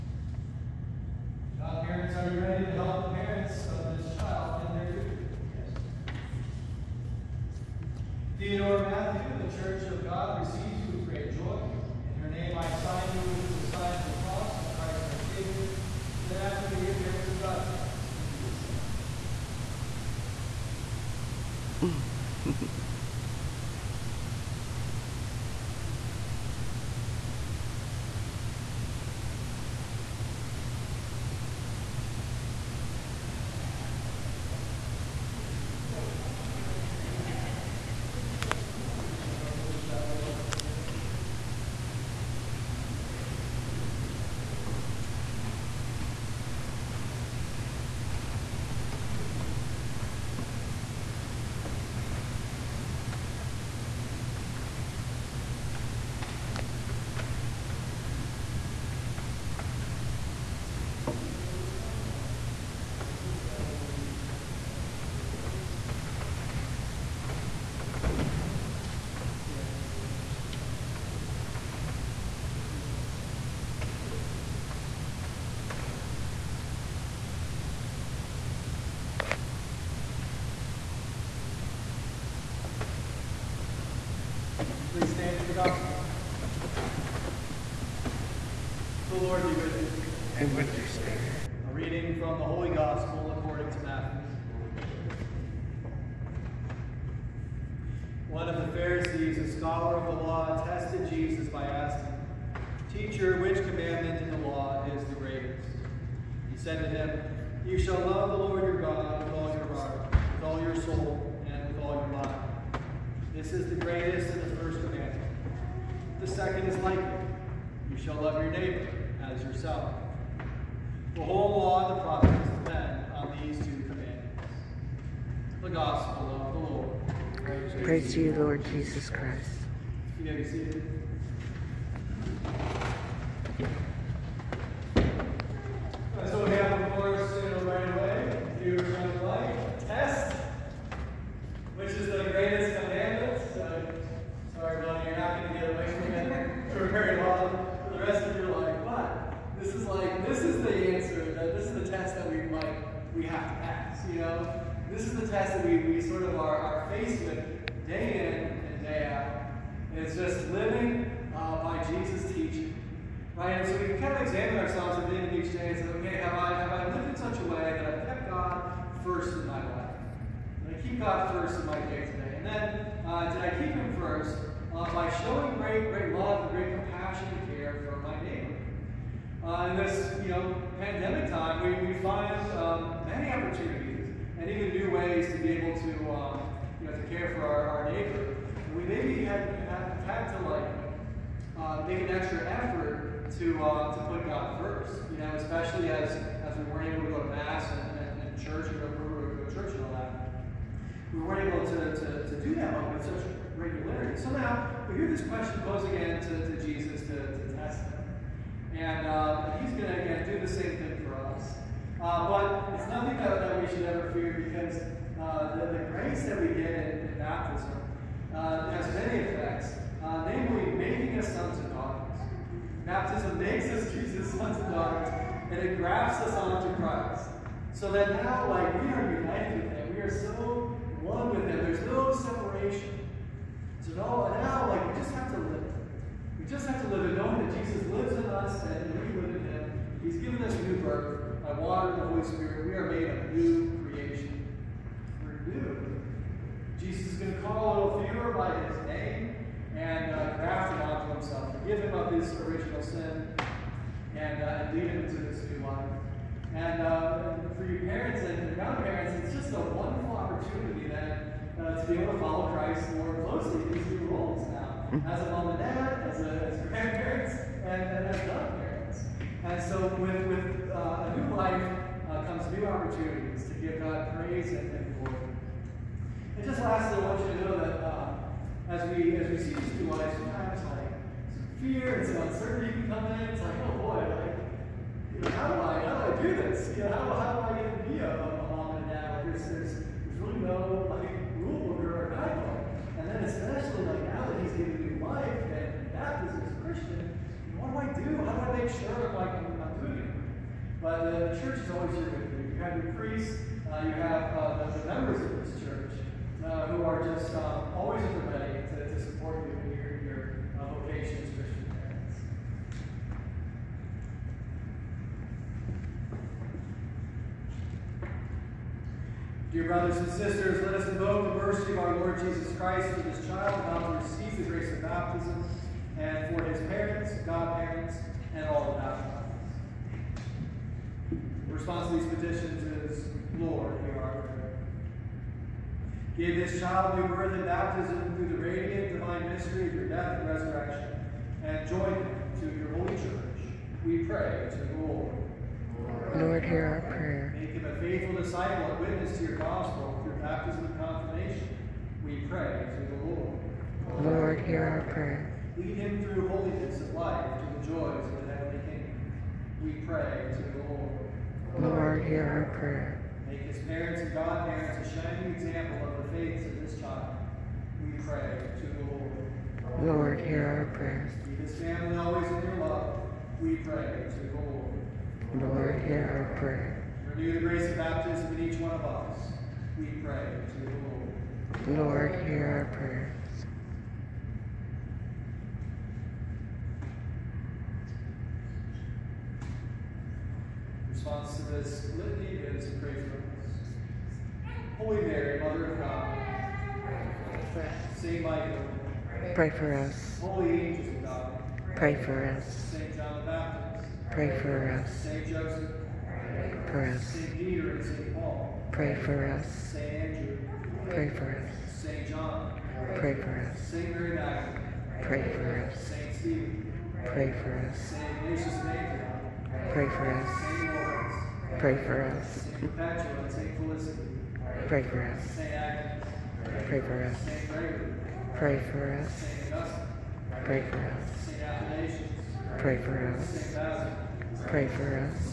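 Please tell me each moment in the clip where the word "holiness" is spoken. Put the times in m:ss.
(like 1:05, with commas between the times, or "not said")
5:56.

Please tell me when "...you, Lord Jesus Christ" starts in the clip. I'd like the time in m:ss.
2:08.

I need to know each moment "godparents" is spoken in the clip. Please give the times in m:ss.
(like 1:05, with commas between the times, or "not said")
4:28, 5:27, 6:04.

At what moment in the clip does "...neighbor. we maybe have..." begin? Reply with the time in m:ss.
3:07.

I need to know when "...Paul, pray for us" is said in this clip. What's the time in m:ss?
6:48.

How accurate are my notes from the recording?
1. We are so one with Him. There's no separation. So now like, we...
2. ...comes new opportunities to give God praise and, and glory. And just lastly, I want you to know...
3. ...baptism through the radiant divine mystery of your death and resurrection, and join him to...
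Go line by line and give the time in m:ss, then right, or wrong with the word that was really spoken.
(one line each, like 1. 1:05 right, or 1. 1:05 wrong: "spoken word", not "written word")
1. 3:49 right
2. 4:32 right
3. 5:37 right.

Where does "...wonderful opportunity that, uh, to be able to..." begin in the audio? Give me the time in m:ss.
4:19.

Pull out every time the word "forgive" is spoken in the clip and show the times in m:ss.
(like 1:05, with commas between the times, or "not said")
4:11.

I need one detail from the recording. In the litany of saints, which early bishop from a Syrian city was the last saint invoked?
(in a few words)
Saint Ignatius of Antioch.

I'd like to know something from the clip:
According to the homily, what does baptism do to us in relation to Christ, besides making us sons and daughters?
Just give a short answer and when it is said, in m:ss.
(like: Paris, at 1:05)
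Grafts us onto Christ, at 3:45.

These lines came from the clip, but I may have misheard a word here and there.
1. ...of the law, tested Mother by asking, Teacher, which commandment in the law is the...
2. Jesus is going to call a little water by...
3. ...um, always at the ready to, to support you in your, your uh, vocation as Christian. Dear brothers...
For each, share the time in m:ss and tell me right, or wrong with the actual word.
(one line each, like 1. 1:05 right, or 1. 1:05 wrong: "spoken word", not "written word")
1. 1:39 wrong: "Jesus", not "Mother"
2. 4:06 wrong: "fewer", not "water"
3. 5:07 right.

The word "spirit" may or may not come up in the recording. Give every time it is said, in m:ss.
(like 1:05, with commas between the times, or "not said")
1:30, 4:02.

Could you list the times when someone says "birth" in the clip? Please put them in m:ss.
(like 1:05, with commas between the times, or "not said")
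4:00, 5:37.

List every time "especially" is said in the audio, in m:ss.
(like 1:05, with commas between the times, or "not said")
3:15.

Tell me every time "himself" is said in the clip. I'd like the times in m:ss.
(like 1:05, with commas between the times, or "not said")
4:11.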